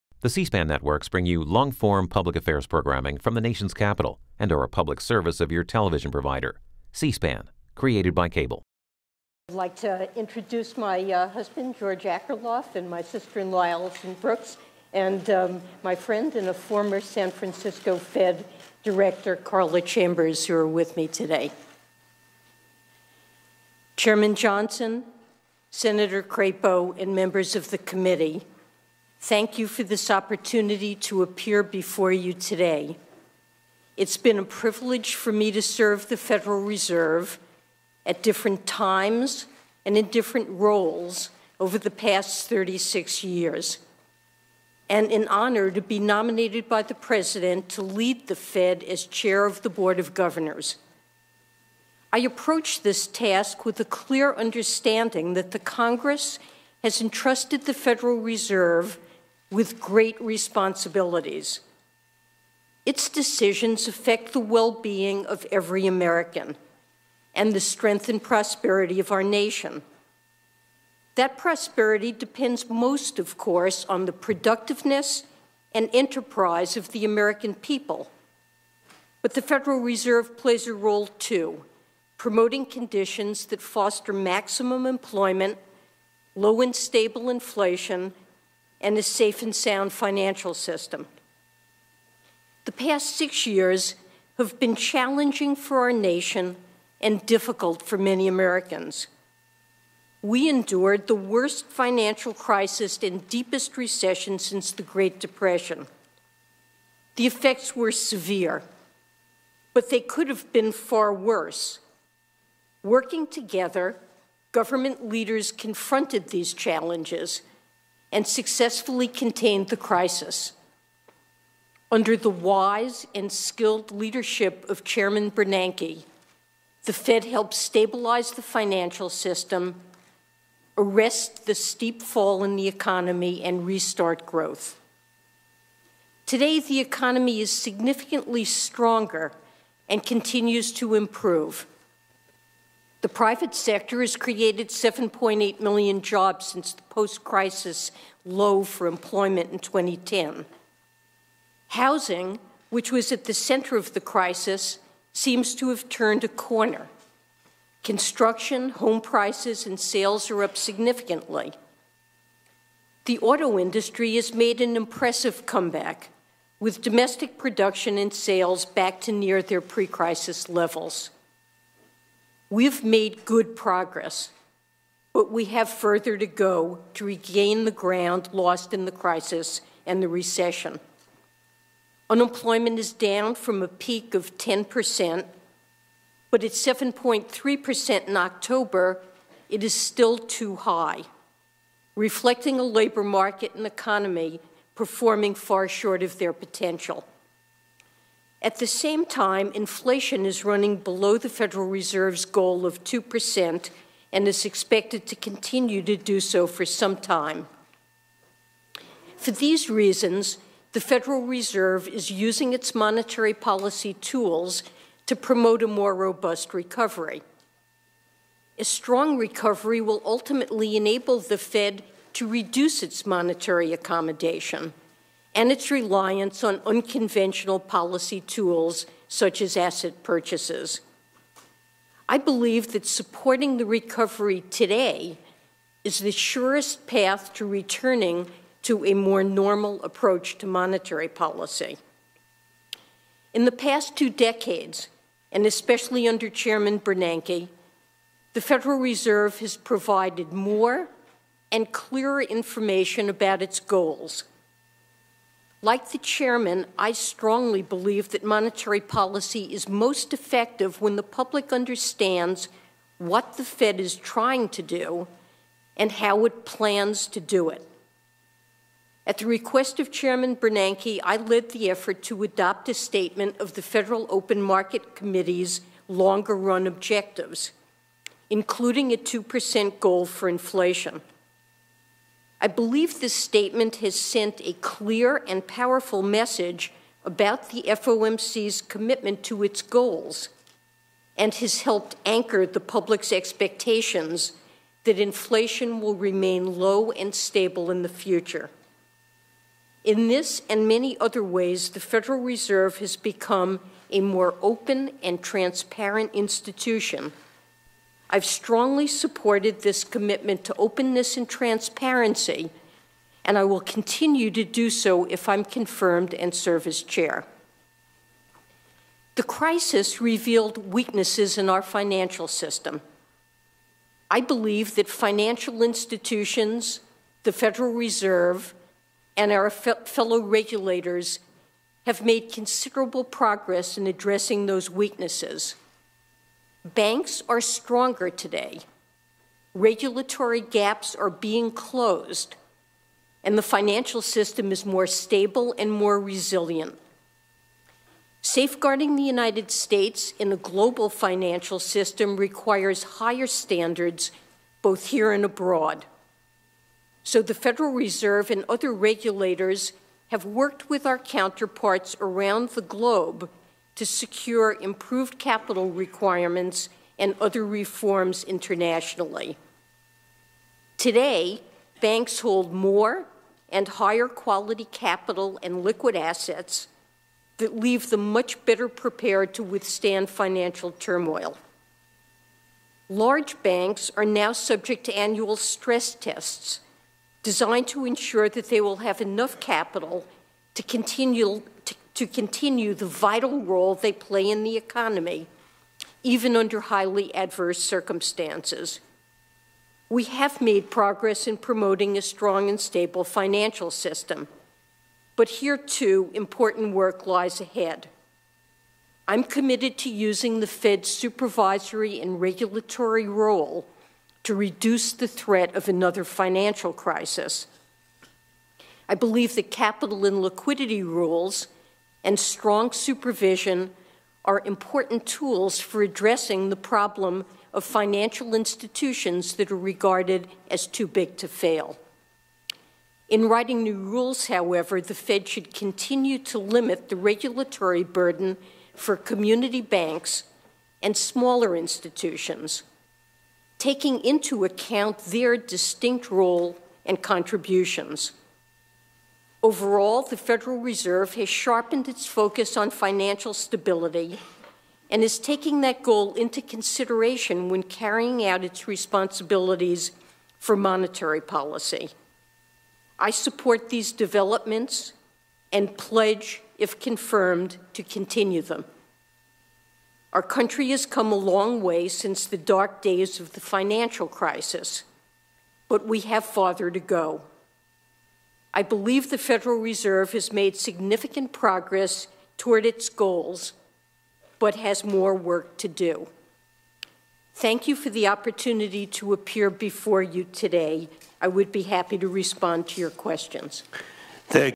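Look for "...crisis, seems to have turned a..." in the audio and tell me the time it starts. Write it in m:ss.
2:33.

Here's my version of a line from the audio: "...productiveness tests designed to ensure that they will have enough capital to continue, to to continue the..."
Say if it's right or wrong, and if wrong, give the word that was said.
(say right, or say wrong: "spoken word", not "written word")
wrong: "stress", not "productiveness".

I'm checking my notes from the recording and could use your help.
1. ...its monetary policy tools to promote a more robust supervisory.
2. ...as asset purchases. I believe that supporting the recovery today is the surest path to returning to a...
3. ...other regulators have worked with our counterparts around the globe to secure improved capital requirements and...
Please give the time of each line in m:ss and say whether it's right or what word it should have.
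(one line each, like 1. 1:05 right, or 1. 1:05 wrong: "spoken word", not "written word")
1. 3:32 wrong: "recovery", not "supervisory"
2. 3:49 right
3. 5:58 right.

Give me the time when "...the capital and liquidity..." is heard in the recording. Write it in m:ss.
6:59.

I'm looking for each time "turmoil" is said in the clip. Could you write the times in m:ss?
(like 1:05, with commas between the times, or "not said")
6:20.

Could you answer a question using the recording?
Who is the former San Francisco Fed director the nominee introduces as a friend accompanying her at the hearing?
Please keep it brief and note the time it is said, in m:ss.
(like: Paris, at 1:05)
Carla Chambers, at 0:19.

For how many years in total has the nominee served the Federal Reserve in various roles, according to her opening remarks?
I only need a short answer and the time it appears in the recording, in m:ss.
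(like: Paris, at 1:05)
36, at 0:42.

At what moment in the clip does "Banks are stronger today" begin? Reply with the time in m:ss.
5:36.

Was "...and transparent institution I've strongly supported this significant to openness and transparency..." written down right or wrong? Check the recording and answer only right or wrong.
wrong.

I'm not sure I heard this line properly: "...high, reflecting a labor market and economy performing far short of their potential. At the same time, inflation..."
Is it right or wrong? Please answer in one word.
right.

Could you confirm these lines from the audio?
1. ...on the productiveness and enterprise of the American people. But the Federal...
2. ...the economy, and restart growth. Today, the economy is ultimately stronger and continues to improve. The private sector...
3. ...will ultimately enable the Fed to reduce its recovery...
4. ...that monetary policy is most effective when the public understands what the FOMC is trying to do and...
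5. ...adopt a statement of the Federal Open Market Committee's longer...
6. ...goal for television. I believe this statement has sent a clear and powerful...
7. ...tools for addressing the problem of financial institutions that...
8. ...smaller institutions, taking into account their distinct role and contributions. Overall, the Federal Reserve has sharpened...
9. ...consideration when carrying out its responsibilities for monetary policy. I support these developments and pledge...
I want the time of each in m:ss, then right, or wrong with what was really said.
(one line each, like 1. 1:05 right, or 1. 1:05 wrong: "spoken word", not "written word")
1. 1:13 right
2. 2:12 wrong: "significantly", not "ultimately"
3. 3:39 wrong: "monetary", not "recovery"
4. 4:18 wrong: "Fed", not "FOMC"
5. 4:32 right
6. 4:39 wrong: "inflation", not "television"
7. 7:05 right
8. 7:20 right
9. 7:36 right.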